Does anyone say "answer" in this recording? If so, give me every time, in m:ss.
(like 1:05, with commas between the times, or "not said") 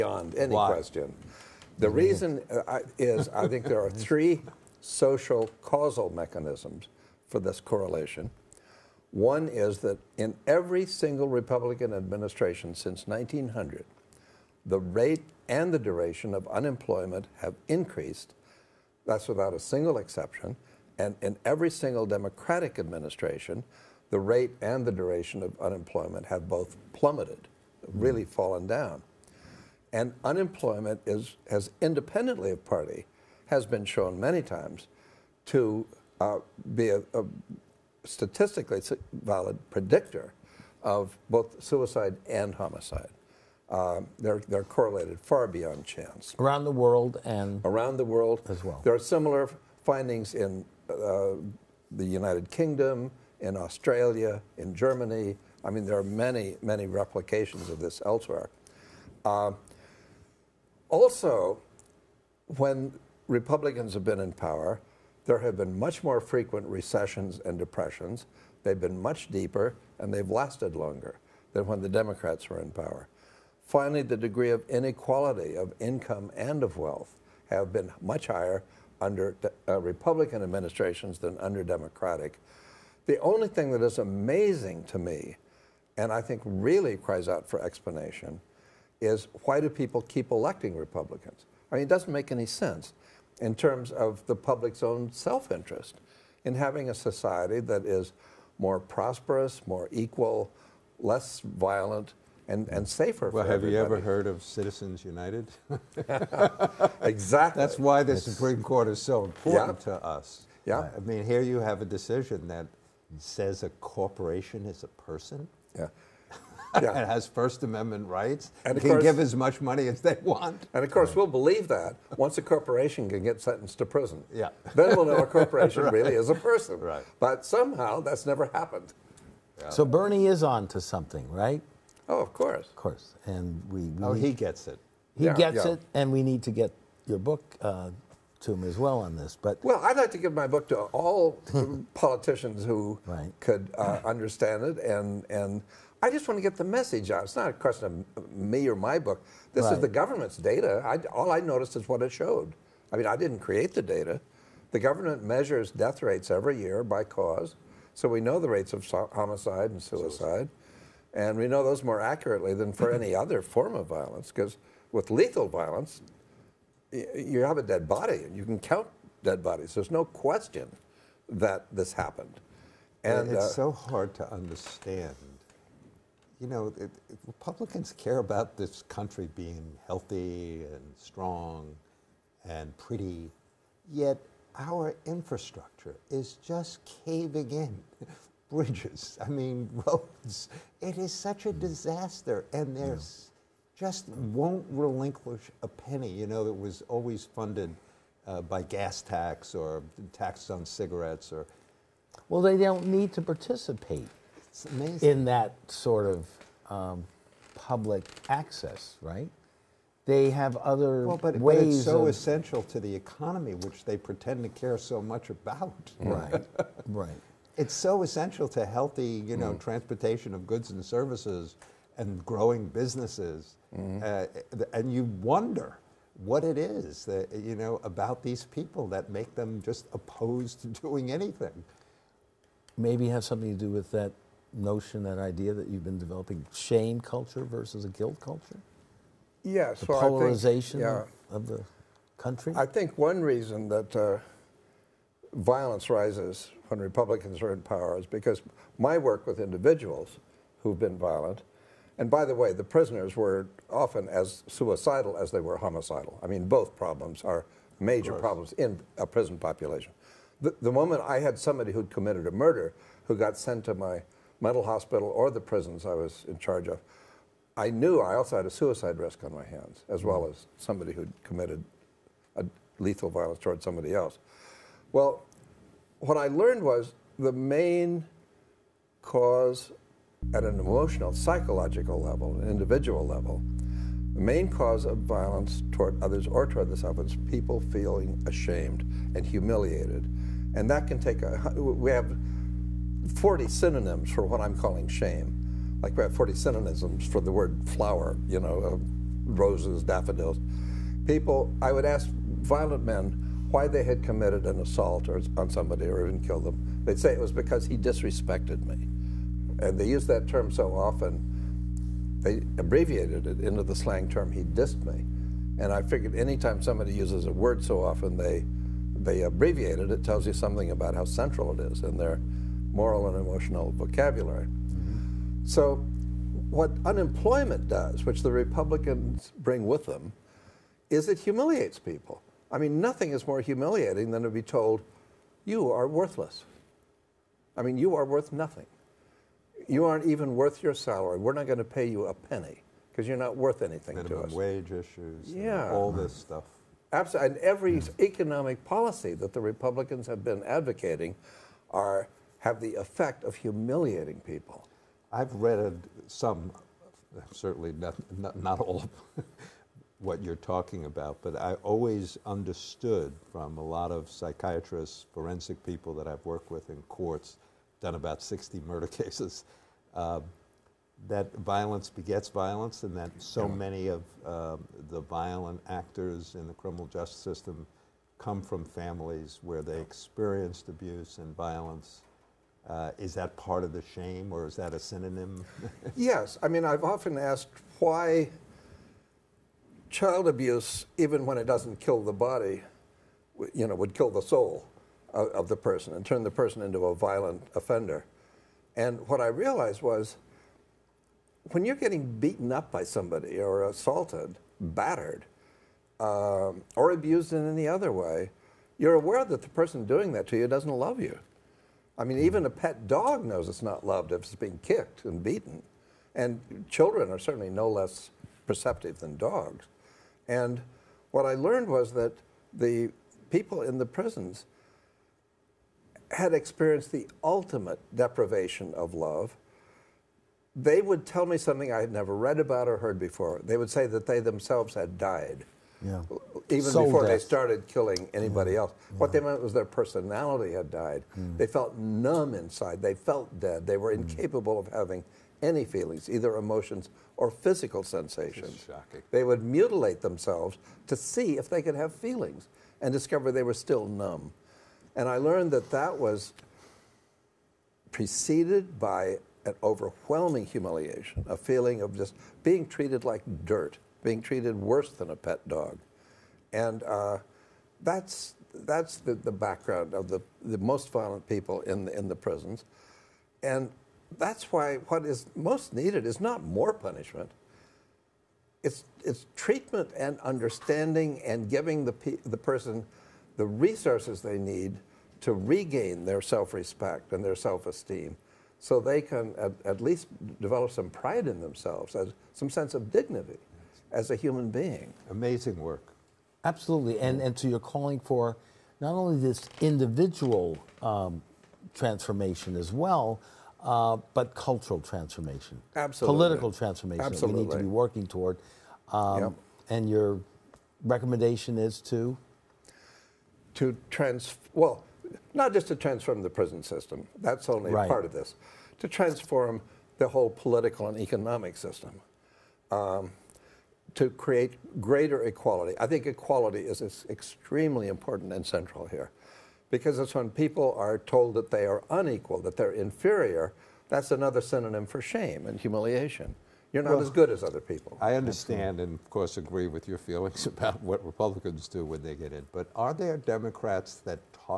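not said.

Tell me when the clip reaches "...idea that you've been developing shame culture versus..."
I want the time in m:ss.
3:55.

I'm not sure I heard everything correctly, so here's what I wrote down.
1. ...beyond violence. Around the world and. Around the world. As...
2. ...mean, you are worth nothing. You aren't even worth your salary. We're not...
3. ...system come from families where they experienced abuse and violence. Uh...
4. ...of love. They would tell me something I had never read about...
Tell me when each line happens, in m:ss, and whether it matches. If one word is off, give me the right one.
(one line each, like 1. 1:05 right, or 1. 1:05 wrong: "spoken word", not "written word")
1. 0:45 wrong: "chance", not "violence"
2. 5:37 right
3. 6:17 right
4. 7:08 right.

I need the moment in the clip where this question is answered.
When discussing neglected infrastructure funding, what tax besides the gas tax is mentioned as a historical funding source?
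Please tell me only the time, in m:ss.
3:20.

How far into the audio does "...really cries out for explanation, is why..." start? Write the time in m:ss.
1:26.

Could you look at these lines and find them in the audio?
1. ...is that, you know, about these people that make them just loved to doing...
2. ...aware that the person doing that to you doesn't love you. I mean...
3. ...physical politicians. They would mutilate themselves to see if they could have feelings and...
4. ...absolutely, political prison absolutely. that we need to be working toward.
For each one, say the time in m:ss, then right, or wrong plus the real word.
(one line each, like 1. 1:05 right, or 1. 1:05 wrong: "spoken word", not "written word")
1. 3:46 wrong: "opposed", not "loved"
2. 6:48 right
3. 7:27 wrong: "sensations", not "politicians"
4. 8:25 wrong: "transformation", not "prison".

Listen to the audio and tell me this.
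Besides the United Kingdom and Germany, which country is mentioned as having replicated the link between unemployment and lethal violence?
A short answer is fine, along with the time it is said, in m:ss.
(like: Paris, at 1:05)
Australia, at 0:53.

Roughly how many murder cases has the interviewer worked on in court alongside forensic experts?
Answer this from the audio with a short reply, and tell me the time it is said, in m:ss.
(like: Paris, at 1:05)
60, at 6:08.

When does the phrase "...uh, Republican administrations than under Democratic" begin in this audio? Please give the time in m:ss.
1:19.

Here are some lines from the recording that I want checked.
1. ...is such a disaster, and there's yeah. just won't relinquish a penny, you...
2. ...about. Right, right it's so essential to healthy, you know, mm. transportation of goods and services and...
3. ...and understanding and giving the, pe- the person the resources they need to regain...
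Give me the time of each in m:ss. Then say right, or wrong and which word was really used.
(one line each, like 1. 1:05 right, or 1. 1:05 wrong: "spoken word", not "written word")
1. 3:10 right
2. 3:35 right
3. 7:59 right.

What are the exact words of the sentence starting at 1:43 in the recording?
you ever heard of Citizens United?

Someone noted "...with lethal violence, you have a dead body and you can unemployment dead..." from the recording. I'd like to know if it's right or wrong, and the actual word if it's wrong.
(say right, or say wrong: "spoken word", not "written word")
wrong: "count", not "unemployment".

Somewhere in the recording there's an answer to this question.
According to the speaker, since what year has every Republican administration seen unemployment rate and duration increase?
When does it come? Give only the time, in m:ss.
0:13.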